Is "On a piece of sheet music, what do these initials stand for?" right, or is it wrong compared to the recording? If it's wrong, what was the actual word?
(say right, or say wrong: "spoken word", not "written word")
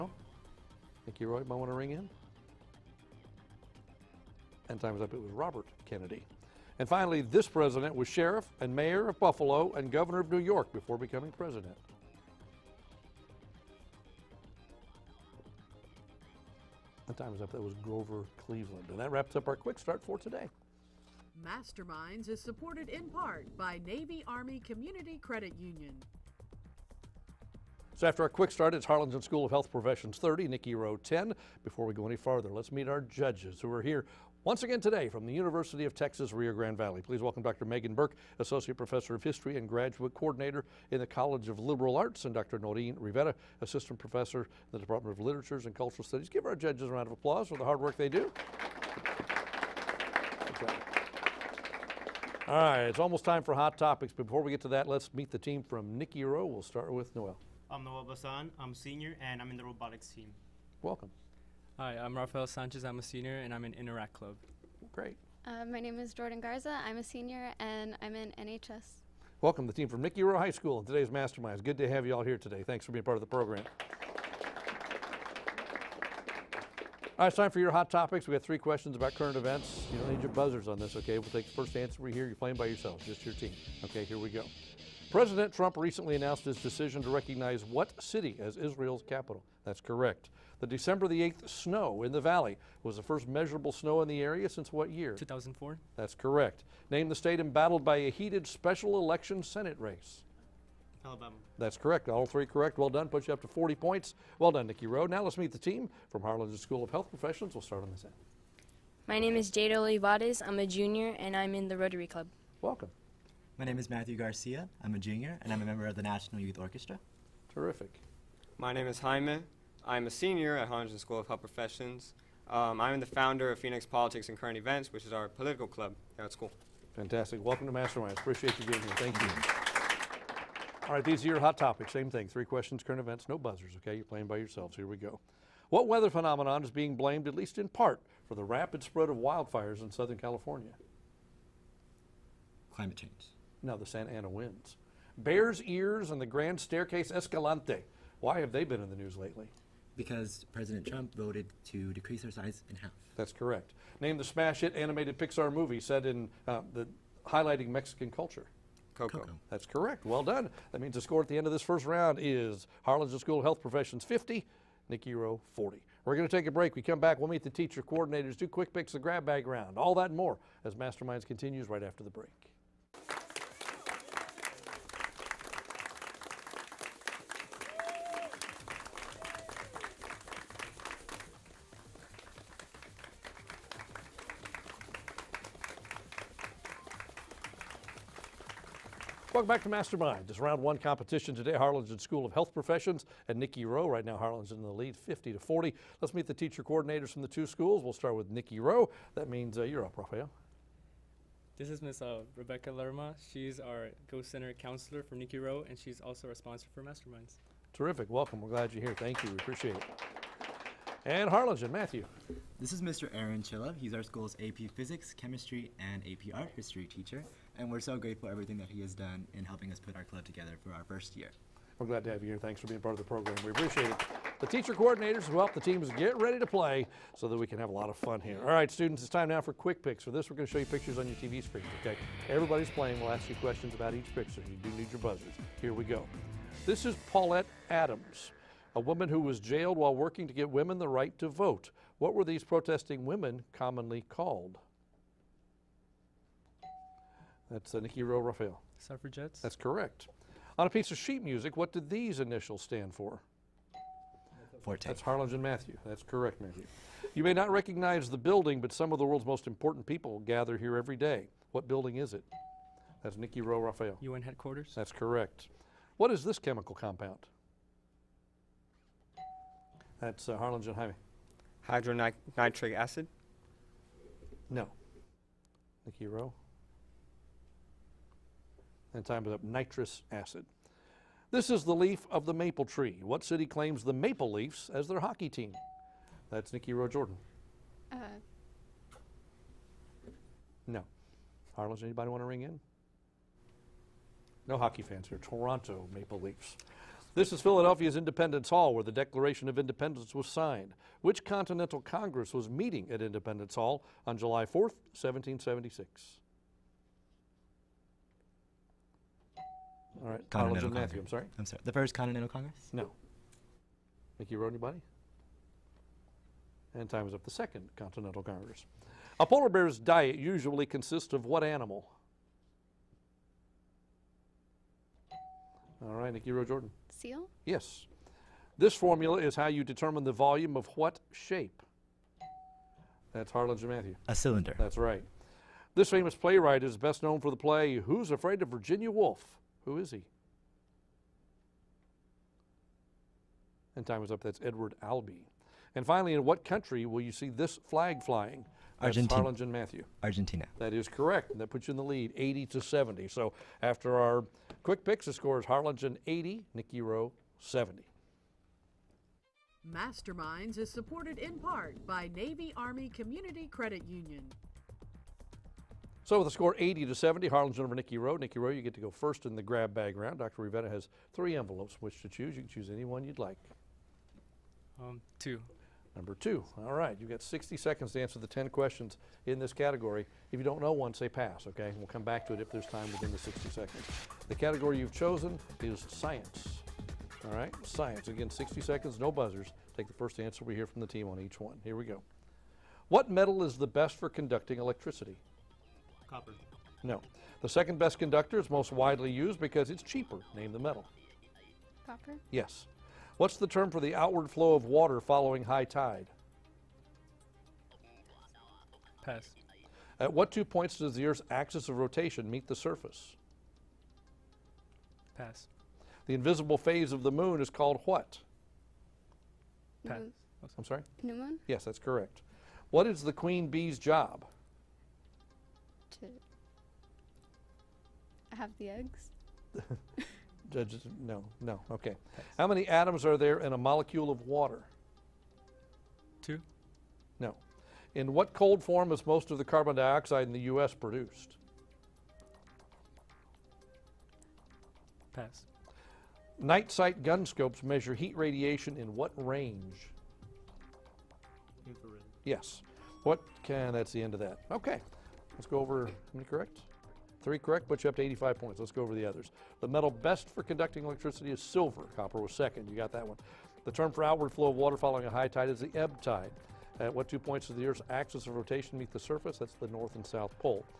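right.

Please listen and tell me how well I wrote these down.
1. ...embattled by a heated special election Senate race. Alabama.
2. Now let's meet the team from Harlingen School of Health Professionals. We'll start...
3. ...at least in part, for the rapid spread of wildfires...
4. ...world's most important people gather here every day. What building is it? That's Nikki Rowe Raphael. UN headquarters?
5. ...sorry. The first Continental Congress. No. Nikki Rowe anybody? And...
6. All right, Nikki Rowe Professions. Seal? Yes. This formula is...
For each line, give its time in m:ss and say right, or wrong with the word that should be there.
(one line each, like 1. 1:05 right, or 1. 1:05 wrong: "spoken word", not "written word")
1. 1:37 right
2. 1:45 right
3. 2:17 right
4. 4:19 right
5. 5:11 right
6. 5:25 wrong: "Jordan", not "Professions".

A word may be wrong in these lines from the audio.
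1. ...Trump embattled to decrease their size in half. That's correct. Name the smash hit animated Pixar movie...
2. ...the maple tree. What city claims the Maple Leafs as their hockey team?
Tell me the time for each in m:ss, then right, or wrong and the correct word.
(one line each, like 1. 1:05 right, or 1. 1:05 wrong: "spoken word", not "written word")
1. 2:30 wrong: "voted", not "embattled"
2. 4:42 right.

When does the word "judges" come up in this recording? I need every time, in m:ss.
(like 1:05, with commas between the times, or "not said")
0:33, 0:46, 7:10.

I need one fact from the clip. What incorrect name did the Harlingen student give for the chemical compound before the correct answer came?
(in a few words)
Hydronitric acid.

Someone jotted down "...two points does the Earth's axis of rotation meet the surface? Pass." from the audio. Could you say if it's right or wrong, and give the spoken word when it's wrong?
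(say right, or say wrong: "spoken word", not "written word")
right.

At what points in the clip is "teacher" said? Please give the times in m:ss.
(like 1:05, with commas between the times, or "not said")
2:47, 3:16, 3:36, 3:44.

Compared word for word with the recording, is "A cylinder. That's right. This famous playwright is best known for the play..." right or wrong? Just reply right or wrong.
right.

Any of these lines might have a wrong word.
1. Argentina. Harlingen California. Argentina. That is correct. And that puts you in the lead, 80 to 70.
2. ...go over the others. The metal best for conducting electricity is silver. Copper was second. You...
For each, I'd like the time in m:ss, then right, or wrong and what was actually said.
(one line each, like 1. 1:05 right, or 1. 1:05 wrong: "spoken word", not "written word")
1. 5:48 wrong: "Matthew", not "California"
2. 7:38 right.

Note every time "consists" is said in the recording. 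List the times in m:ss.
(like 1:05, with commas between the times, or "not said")
5:20.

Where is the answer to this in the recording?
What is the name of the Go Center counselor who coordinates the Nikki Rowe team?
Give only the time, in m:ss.
3:22.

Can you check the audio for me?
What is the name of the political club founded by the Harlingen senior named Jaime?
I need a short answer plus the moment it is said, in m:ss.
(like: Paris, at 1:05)
Phoenix Politics and Current Events, at 2:03.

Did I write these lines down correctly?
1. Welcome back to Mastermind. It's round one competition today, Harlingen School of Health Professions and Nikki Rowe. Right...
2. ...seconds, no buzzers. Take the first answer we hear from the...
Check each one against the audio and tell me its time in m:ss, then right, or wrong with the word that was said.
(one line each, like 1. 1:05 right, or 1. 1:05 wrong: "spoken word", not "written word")
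1. 3:09 right
2. 6:28 right.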